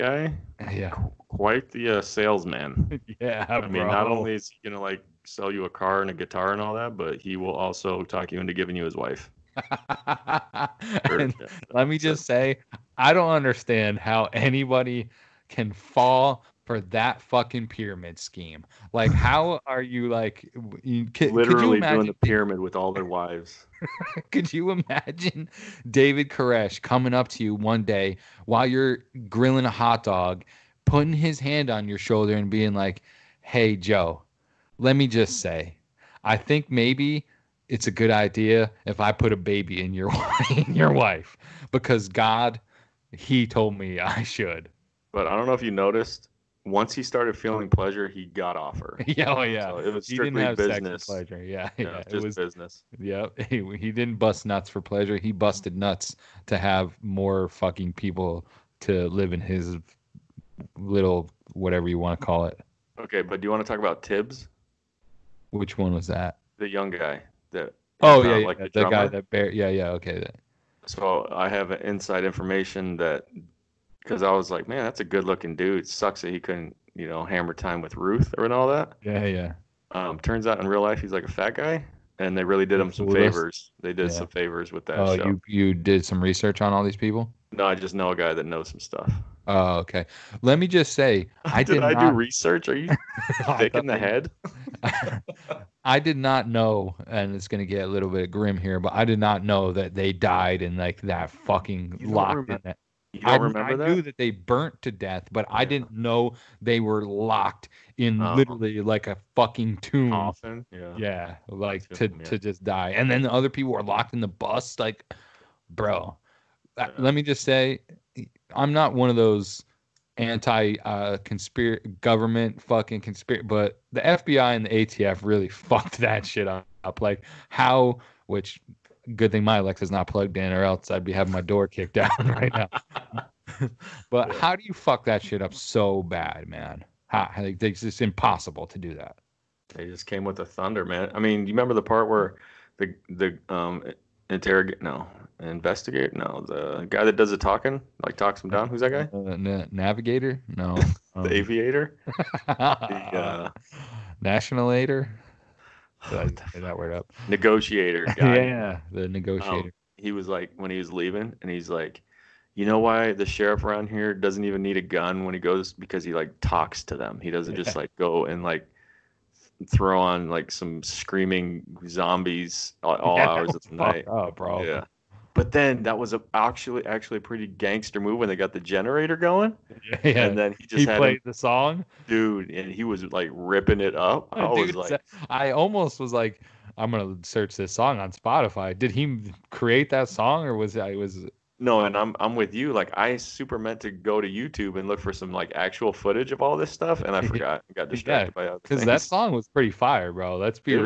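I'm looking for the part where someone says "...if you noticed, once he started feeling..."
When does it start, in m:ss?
0:45.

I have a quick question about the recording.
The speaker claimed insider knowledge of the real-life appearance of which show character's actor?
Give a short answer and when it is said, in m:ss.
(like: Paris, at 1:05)
Tibbs, at 1:04.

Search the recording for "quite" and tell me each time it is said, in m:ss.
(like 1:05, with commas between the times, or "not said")
0:01.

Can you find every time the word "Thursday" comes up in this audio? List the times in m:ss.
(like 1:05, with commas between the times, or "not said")
not said.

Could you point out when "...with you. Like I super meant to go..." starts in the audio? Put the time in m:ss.
3:12.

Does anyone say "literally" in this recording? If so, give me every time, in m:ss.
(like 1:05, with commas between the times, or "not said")
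0:21, 1:48.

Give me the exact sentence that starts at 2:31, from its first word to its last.
aviator the uh, nationalator did I say that word up?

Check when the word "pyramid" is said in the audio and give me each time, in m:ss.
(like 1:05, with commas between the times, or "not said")
0:17, 0:22.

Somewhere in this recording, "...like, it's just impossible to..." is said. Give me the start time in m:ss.
2:17.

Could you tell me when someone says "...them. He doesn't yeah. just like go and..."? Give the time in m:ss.
2:46.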